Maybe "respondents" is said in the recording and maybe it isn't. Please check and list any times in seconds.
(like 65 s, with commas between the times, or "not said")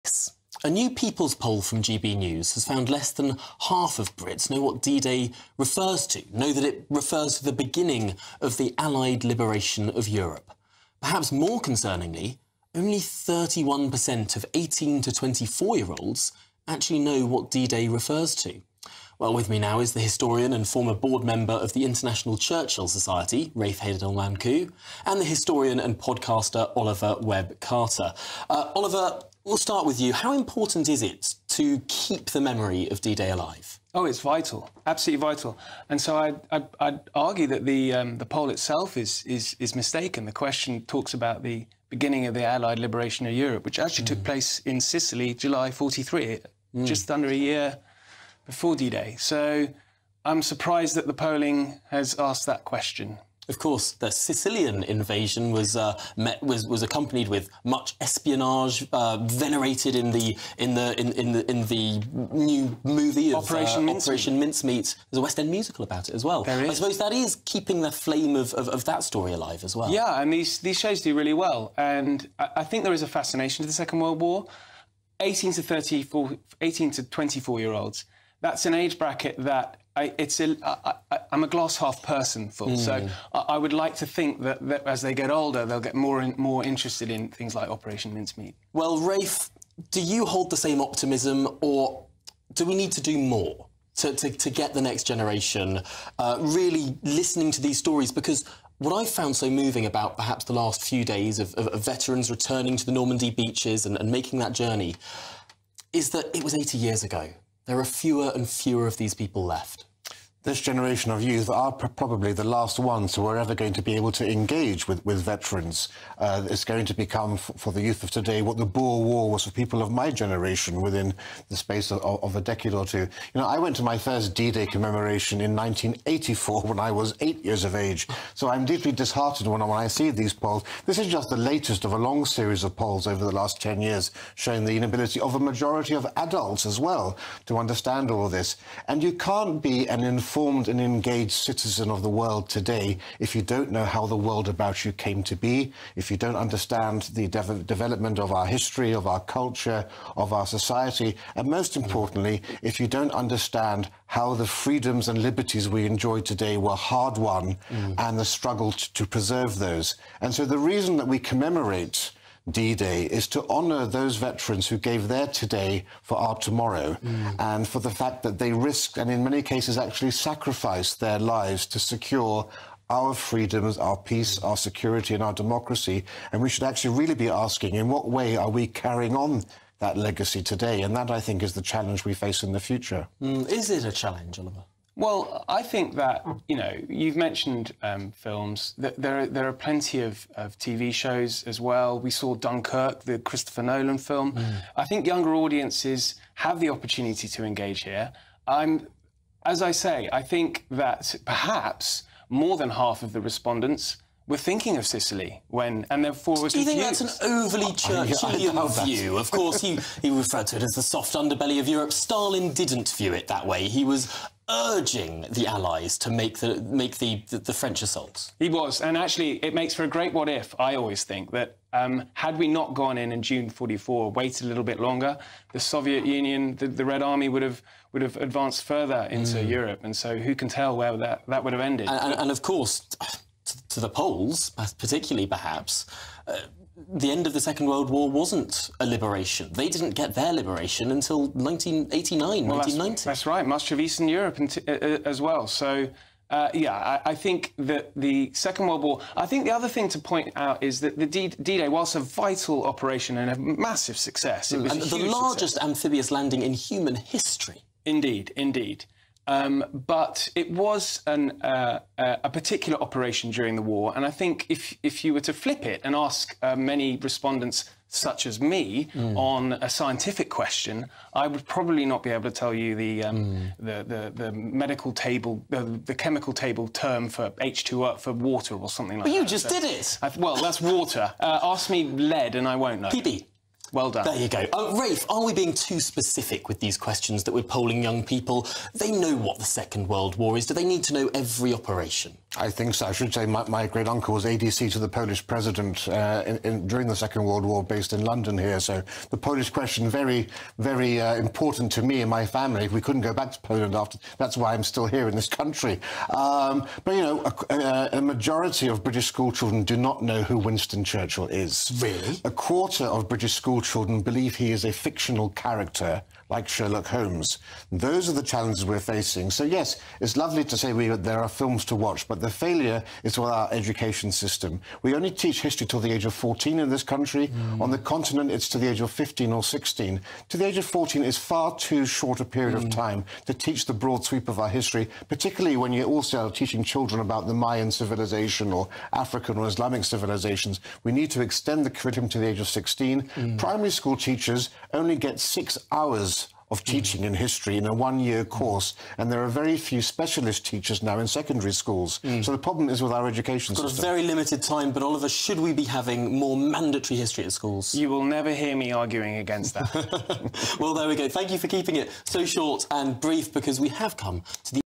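203 s, 266 s.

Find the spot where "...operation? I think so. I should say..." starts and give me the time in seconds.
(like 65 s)
291 s.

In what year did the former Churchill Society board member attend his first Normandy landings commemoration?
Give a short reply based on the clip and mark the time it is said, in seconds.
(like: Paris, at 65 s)
1984, at 125 s.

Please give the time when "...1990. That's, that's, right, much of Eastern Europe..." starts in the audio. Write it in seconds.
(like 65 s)
242 s.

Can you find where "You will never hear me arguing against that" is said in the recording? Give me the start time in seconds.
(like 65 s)
357 s.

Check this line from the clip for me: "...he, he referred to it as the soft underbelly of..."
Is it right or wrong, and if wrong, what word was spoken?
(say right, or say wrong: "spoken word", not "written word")
right.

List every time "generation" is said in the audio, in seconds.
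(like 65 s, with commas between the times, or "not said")
95 s, 110 s, 120 s.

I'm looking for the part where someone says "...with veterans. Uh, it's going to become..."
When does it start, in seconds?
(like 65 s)
115 s.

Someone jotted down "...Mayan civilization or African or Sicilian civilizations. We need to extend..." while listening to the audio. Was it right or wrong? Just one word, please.
wrong.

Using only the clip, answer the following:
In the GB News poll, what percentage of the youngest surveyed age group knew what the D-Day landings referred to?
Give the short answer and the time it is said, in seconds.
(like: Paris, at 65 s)
31%, at 12 s.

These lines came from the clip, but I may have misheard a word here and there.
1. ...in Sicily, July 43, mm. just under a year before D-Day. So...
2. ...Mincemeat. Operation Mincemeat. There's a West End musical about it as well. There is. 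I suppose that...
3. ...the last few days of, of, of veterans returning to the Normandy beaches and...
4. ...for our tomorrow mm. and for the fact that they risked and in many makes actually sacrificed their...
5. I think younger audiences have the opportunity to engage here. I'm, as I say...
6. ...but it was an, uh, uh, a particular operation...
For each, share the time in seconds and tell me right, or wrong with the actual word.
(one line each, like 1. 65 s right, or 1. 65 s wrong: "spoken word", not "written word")
1. 44 s right
2. 63 s right
3. 100 s right
4. 166 s wrong: "cases", not "makes"
5. 194 s right
6. 259 s right.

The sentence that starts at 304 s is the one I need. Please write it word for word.
That's why I'm still here in this country.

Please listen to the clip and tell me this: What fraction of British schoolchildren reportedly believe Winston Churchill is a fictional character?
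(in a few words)
A quarter.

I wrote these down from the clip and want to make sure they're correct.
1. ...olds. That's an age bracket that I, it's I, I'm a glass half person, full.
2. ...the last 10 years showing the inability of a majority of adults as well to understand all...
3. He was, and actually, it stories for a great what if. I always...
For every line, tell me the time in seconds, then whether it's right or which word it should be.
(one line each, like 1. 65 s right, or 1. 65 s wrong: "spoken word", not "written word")
1. 77 s right
2. 133 s right
3. 218 s wrong: "makes", not "stories".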